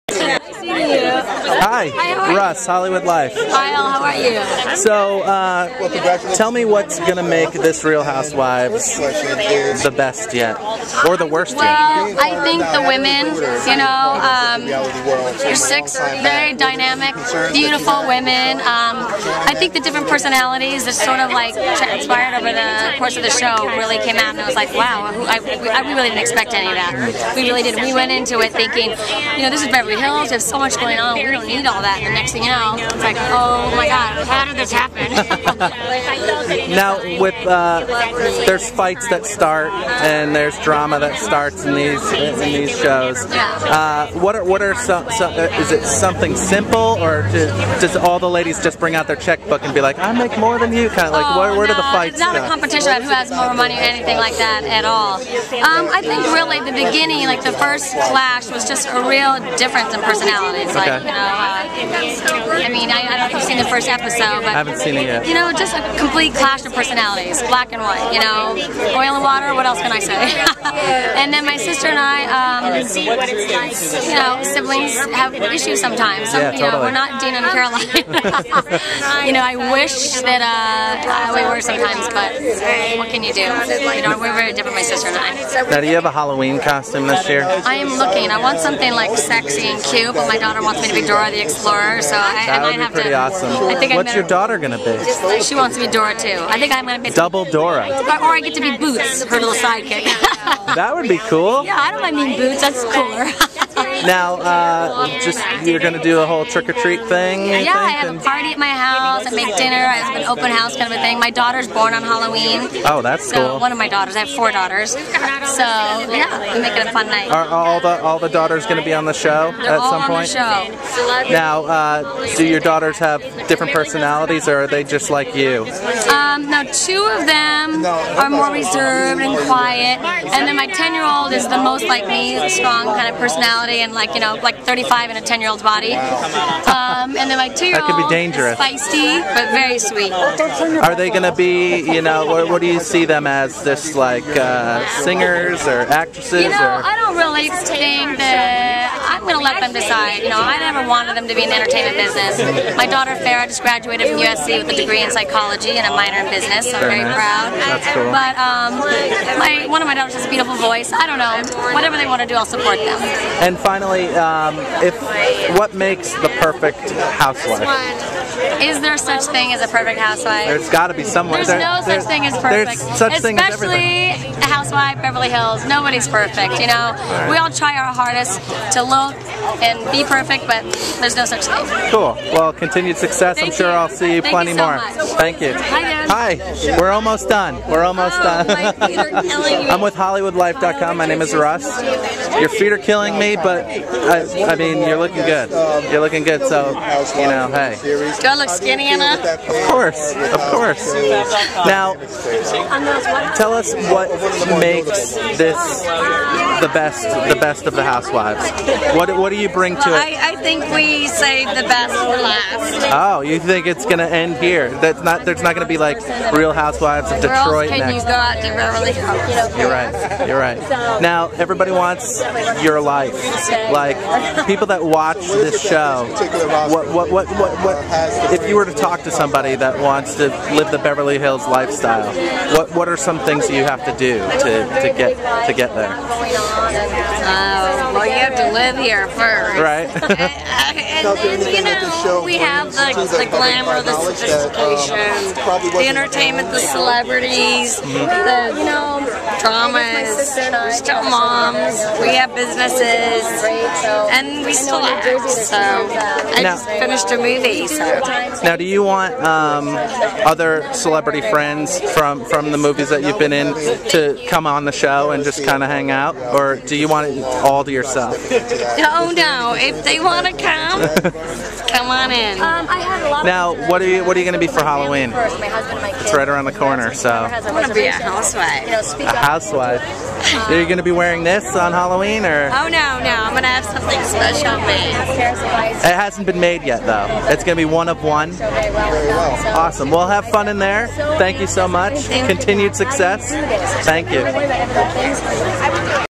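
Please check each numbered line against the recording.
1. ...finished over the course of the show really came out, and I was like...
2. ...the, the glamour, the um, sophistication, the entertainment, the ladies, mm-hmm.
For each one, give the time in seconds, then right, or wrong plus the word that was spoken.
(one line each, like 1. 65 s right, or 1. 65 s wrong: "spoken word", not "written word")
1. 21 s wrong: "transpired", not "finished"
2. 242 s wrong: "celebrities", not "ladies".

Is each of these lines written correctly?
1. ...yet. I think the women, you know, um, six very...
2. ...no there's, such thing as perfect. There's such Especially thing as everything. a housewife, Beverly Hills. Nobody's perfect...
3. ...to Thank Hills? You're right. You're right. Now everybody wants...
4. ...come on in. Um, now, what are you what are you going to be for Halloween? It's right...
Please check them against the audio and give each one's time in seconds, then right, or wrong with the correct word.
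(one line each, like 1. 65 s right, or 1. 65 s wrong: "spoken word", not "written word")
1. 12 s right
2. 171 s right
3. 218 s wrong: "Beverly", not "Thank"
4. 271 s right.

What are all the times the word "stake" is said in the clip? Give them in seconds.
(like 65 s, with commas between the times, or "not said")
not said.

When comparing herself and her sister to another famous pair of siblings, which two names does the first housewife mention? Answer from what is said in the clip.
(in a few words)
Dina and Caroline.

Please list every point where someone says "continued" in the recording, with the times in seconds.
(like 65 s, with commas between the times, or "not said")
182 s, 292 s.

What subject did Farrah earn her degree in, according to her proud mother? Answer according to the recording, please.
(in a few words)
Psychology.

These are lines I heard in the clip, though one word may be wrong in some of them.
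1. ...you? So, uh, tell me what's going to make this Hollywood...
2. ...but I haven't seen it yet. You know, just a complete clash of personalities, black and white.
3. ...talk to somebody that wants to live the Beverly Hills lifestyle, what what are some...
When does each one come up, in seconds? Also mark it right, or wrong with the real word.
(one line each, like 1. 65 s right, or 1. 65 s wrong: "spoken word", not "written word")
1. 4 s wrong: "Real", not "Hollywood"
2. 64 s right
3. 228 s right.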